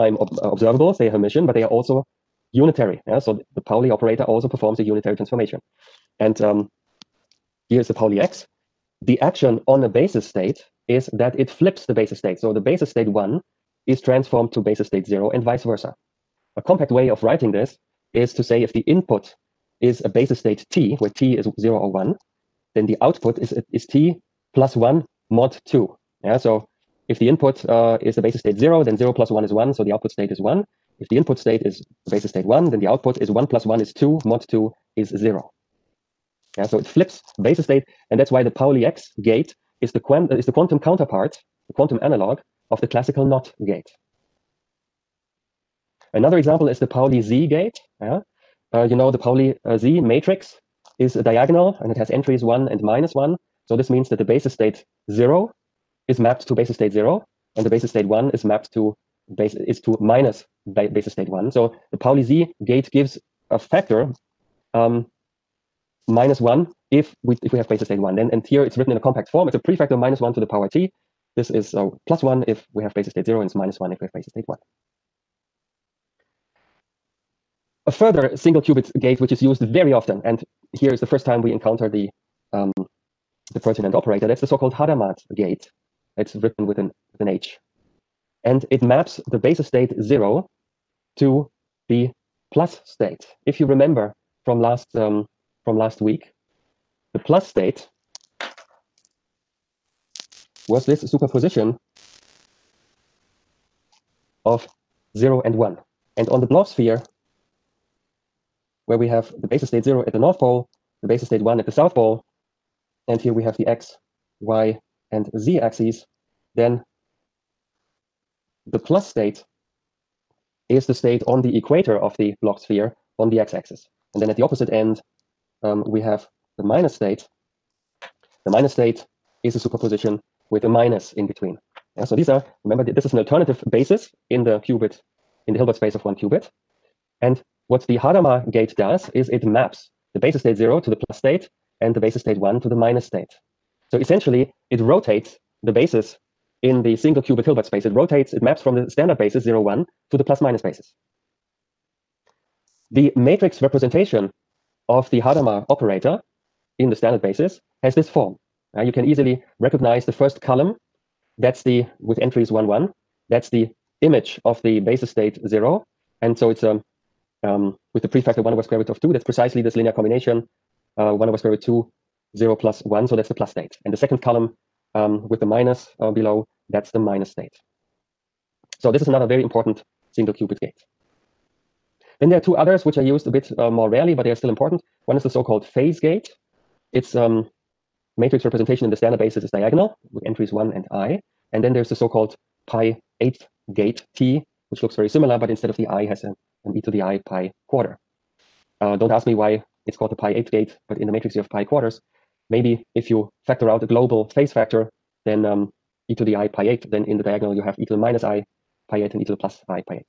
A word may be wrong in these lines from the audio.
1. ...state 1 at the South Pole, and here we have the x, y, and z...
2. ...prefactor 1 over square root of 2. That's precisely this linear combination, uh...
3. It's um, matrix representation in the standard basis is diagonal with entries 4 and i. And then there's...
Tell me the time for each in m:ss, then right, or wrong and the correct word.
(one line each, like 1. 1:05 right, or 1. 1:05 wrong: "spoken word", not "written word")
1. 1:51 right
2. 2:48 right
3. 3:06 wrong: "1", not "4".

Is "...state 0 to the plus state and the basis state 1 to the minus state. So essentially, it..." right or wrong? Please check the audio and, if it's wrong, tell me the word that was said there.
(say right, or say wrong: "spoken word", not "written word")
right.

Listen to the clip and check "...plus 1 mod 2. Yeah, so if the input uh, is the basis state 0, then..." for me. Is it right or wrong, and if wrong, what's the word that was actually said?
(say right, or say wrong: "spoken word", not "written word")
right.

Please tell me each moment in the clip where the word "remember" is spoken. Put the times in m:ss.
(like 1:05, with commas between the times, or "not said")
1:33, 2:12.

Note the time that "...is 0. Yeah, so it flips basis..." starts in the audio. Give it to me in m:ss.
0:34.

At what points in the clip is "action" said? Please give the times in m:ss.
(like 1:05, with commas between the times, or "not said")
0:09.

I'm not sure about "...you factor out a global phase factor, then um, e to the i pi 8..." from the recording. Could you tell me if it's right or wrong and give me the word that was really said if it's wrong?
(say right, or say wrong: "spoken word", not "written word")
right.